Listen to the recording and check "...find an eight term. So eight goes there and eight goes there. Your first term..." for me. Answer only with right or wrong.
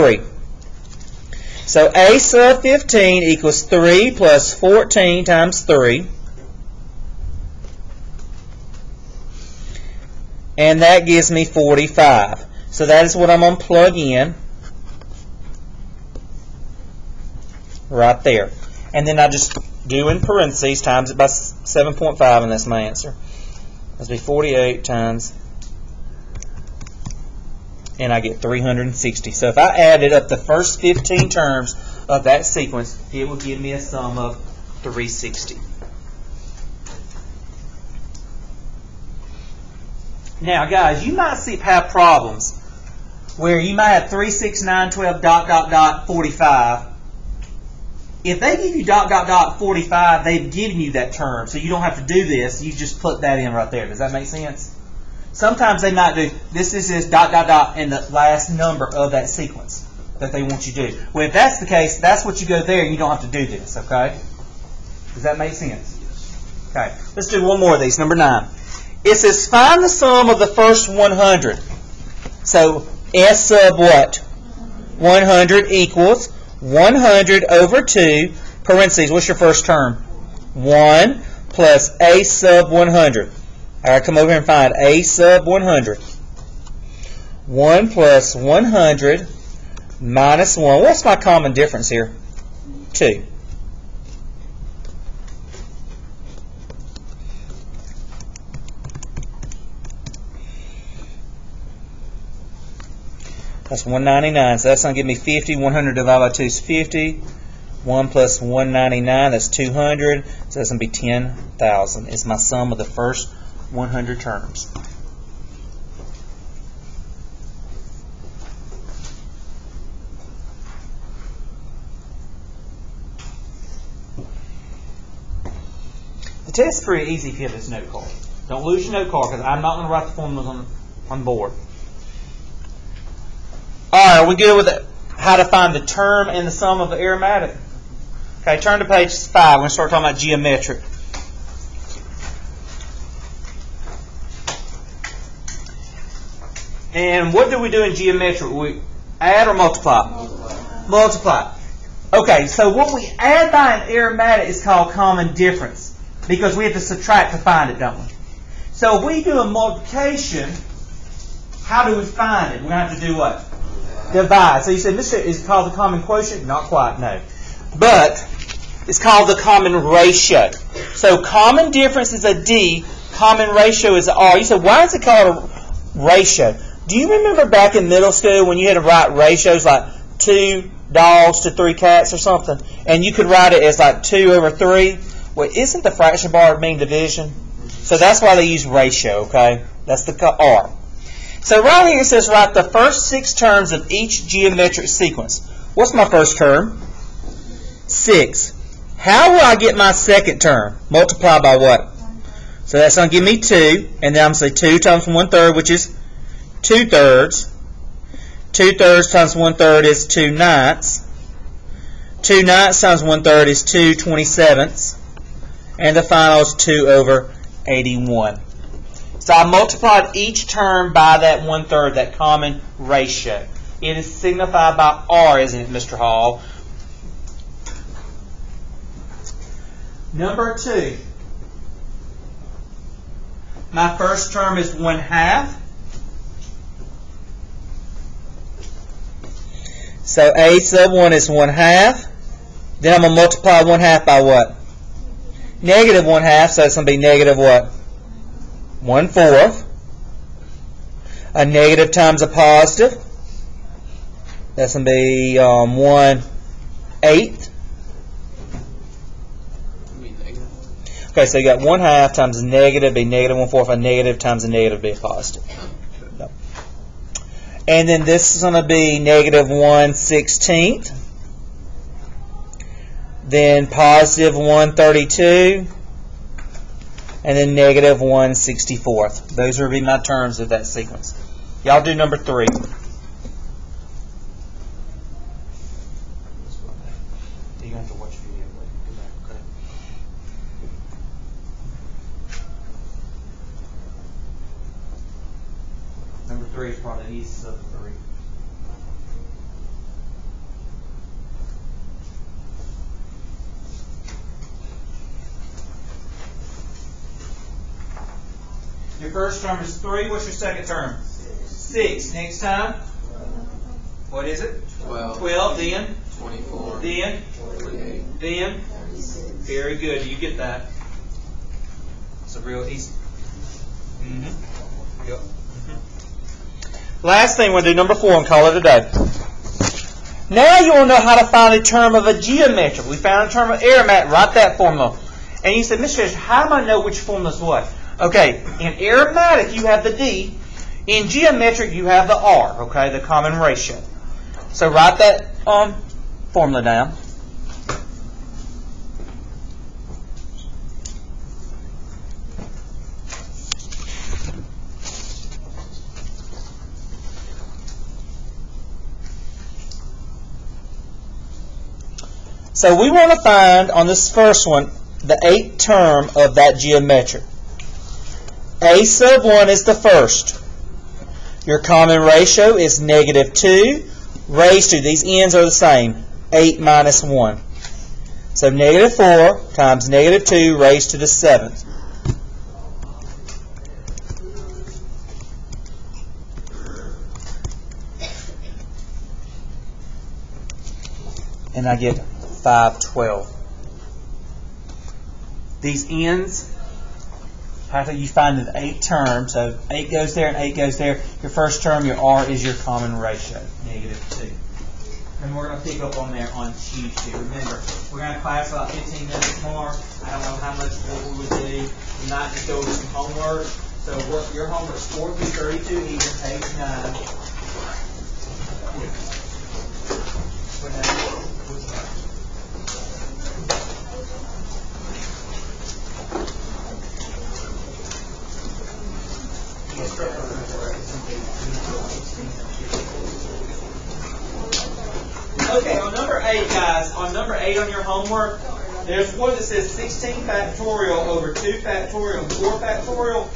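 right.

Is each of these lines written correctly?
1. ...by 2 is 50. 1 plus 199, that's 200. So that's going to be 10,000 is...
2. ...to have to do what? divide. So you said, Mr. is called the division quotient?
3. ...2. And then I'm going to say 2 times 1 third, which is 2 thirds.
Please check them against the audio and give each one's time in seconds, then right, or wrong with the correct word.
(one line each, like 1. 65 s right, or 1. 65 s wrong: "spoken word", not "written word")
1. 106 s right
2. 162 s wrong: "common", not "division"
3. 203 s right.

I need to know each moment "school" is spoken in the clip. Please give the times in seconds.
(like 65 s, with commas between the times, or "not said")
178 s.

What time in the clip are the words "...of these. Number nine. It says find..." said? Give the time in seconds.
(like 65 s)
67 s.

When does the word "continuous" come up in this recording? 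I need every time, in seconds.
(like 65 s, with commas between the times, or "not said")
not said.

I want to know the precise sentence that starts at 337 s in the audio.
Okay, in arithmetic you have the D.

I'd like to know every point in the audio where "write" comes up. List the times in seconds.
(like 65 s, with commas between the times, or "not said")
129 s, 178 s, 183 s, 192 s, 334 s, 344 s.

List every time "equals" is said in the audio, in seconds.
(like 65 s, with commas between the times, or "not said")
3 s, 75 s.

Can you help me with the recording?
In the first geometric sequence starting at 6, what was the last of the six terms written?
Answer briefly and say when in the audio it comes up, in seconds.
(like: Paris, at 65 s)
2/81, at 216 s.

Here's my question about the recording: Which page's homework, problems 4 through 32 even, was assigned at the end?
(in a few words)
9.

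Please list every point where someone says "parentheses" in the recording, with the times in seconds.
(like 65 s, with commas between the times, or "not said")
20 s, 78 s.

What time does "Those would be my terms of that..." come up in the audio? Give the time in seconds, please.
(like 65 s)
279 s.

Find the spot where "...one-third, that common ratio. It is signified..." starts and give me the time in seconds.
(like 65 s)
221 s.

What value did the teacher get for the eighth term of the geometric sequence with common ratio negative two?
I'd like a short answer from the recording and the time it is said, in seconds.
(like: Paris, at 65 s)
512, at 391 s.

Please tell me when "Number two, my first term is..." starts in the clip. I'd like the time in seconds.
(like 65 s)
230 s.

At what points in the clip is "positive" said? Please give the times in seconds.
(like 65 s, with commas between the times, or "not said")
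252 s, 264 s, 273 s.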